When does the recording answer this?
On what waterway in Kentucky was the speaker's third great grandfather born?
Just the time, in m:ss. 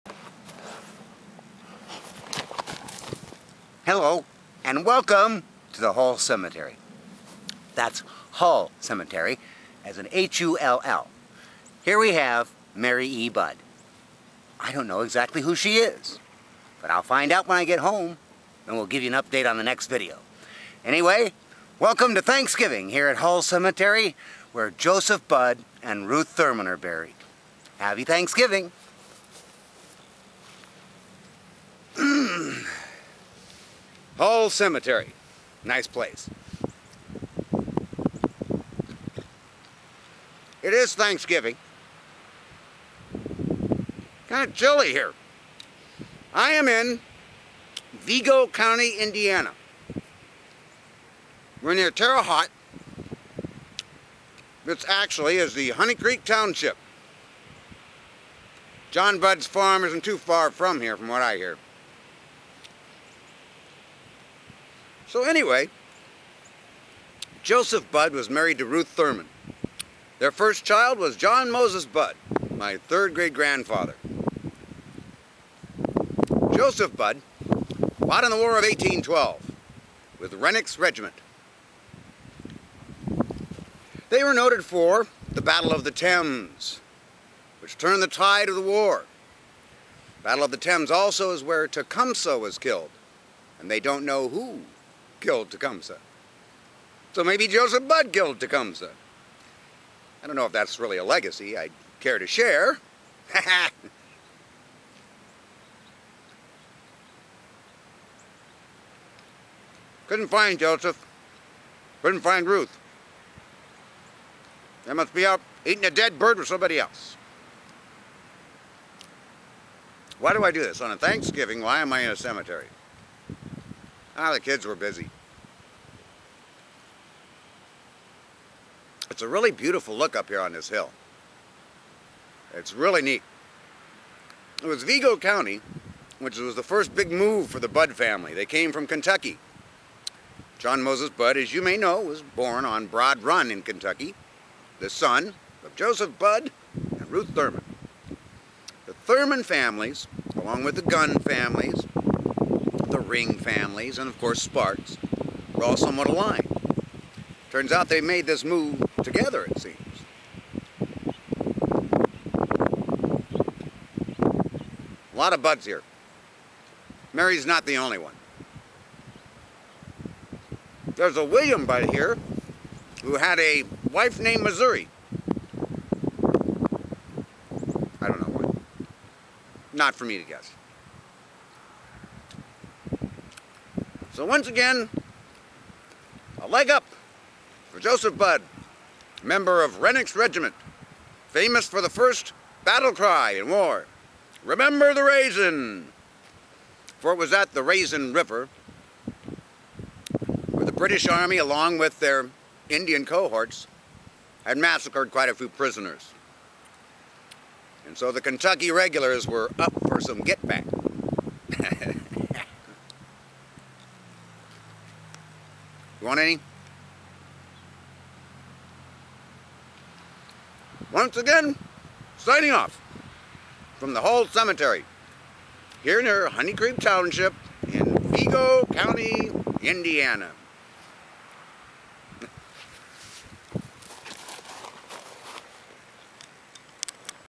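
2:22.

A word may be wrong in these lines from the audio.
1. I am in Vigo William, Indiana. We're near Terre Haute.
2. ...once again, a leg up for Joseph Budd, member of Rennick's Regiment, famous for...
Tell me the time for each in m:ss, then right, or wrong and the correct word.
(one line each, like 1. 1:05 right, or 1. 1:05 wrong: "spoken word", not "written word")
1. 0:46 wrong: "County", not "William"
2. 3:04 right.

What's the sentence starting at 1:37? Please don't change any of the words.
So maybe Joseph Budd killed Tecumseh.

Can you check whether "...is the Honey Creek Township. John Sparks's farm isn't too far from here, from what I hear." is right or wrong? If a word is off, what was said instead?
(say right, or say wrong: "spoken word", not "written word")
wrong: "Budd", not "Sparks".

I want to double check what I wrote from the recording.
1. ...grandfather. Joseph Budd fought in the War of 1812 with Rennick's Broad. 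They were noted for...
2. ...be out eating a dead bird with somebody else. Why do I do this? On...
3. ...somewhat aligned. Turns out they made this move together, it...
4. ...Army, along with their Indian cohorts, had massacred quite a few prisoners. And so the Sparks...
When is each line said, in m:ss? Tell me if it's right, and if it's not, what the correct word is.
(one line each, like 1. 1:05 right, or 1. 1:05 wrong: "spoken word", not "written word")
1. 1:13 wrong: "Regiment", not "Broad"
2. 1:55 right
3. 2:35 right
4. 3:21 wrong: "Kentucky", not "Sparks".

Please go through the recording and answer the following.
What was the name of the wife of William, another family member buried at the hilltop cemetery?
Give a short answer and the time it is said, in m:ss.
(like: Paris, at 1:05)
Missouri, at 2:54.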